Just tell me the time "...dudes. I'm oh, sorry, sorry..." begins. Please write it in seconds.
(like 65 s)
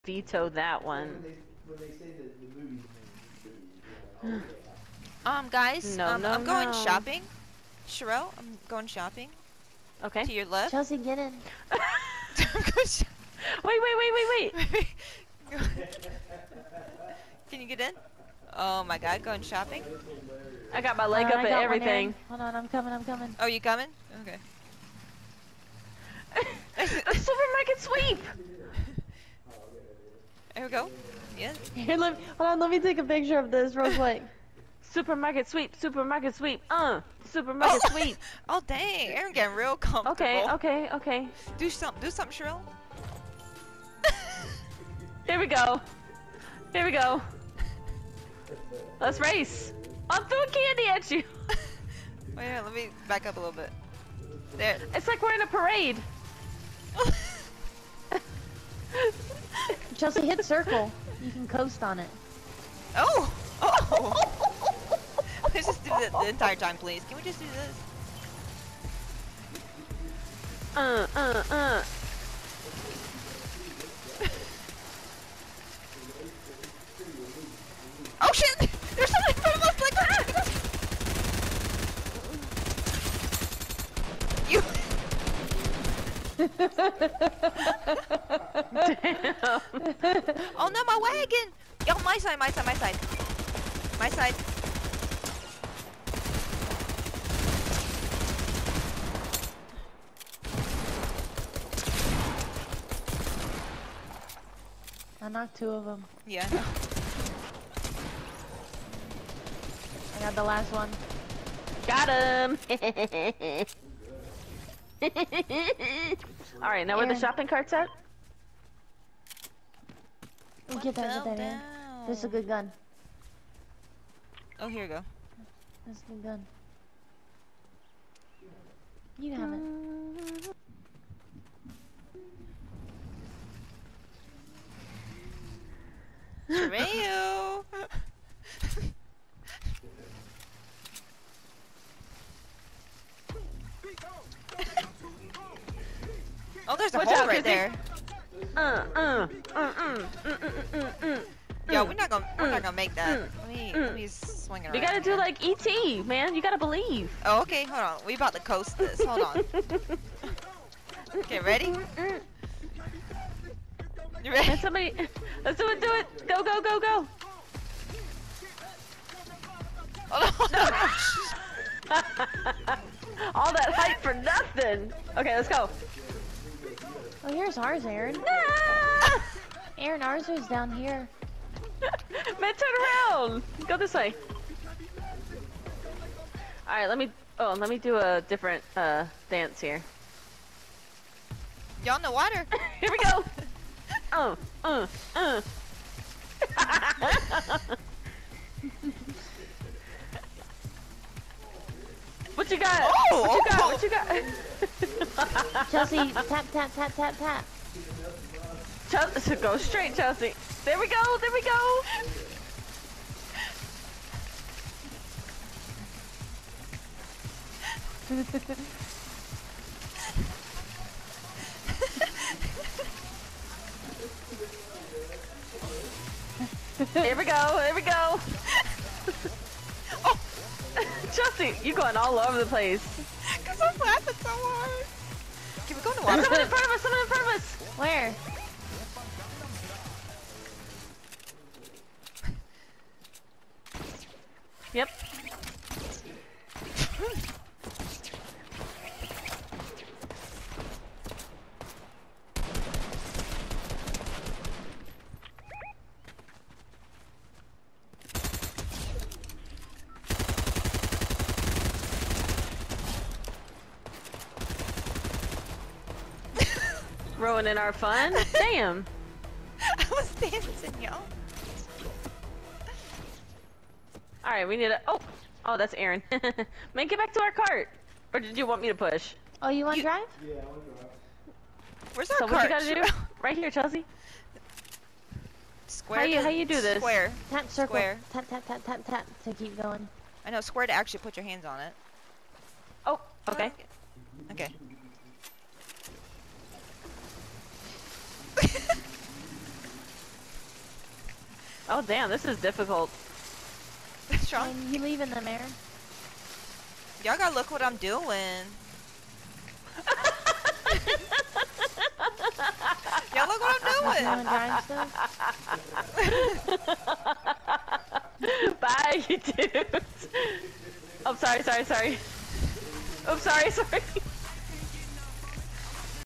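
319 s.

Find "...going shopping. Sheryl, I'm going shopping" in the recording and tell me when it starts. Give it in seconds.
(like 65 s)
6 s.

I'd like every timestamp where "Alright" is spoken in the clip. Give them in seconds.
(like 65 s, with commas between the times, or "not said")
115 s, 186 s, 274 s.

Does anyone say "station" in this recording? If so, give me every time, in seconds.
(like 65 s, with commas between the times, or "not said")
not said.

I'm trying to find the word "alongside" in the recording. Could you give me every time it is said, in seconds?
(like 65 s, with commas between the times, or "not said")
not said.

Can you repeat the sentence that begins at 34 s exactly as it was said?
supermarket sweep, supermarket sweep, uh, supermarket oh.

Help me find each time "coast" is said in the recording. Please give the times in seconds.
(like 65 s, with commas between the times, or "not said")
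61 s, 158 s.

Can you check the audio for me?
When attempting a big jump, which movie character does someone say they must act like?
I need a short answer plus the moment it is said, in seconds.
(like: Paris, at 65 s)
ET, at 155 s.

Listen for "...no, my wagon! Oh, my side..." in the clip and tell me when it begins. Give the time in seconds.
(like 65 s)
90 s.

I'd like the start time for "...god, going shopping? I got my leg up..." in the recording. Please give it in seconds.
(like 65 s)
18 s.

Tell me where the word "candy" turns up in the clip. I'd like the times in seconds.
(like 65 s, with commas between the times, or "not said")
50 s.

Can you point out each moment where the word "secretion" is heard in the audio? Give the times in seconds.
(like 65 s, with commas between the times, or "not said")
not said.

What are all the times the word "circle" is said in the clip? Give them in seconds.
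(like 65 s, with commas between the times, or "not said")
60 s, 287 s.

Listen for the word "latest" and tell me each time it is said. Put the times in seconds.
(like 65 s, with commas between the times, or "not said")
not said.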